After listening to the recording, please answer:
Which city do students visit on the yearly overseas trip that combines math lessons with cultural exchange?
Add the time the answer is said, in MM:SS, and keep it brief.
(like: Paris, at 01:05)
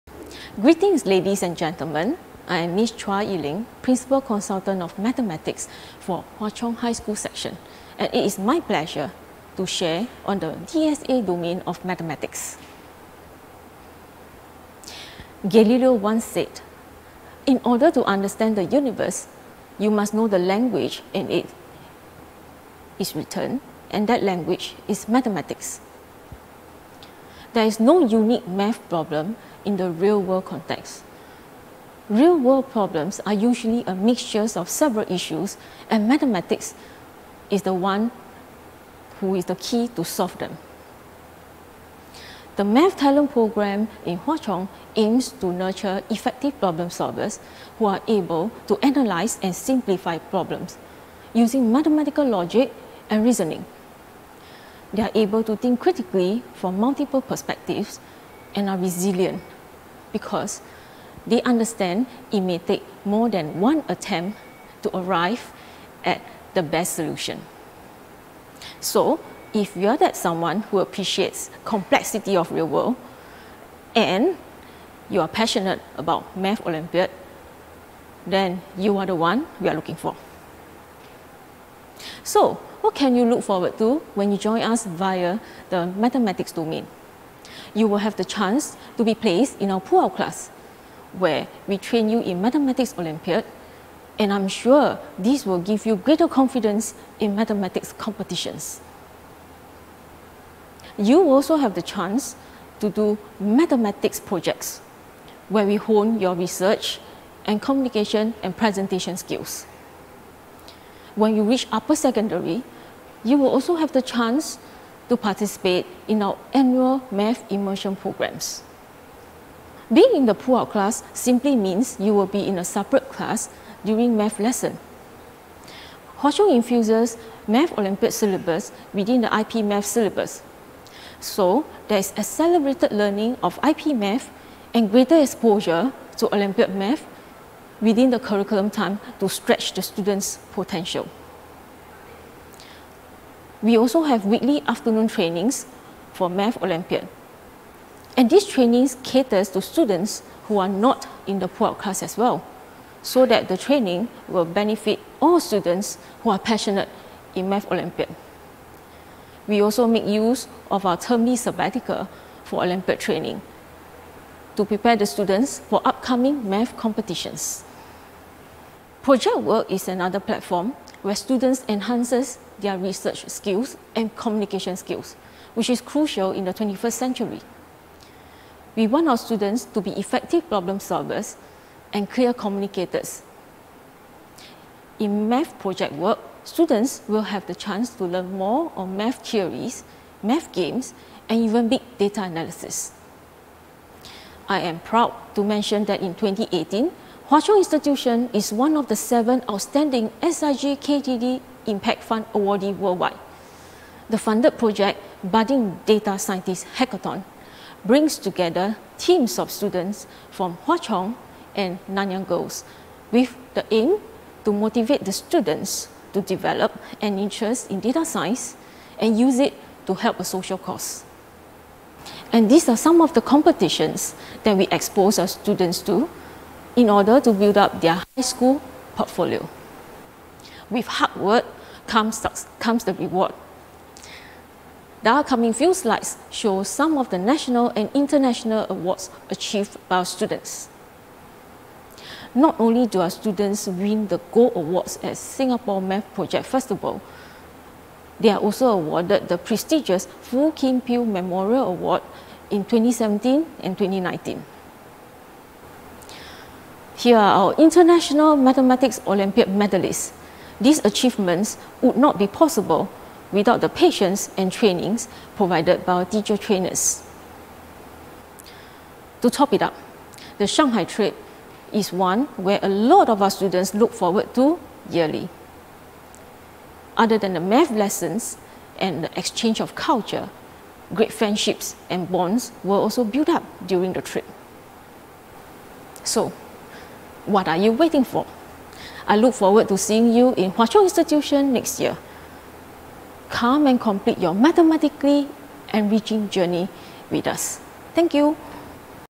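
Shanghai, at 04:30.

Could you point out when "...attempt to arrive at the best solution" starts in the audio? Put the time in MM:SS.
01:03.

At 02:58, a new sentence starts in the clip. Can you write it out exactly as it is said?
We want our students to be effective problem solvers and clear communicators.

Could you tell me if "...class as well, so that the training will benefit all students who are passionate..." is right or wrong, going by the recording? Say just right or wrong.
right.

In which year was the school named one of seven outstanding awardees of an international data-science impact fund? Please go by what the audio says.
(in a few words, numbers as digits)
2018.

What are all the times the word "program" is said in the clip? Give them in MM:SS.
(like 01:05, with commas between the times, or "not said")
00:43, 01:57.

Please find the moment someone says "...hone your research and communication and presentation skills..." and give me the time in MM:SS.
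01:45.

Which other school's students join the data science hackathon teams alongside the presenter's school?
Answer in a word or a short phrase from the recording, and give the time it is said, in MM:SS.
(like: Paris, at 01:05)
Nanyang Girls, at 03:31.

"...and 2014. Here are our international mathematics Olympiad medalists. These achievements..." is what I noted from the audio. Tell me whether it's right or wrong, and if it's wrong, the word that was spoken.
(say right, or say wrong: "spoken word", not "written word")
wrong: "2019", not "2014".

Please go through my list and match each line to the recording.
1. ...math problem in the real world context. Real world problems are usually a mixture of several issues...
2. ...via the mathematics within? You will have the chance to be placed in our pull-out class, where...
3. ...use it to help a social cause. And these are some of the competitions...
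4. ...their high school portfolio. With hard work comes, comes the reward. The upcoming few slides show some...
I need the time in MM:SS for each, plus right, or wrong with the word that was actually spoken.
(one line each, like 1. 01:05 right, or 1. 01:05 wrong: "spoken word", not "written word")
1. 00:28 right
2. 01:24 wrong: "domain", not "within"
3. 03:39 right
4. 03:47 right.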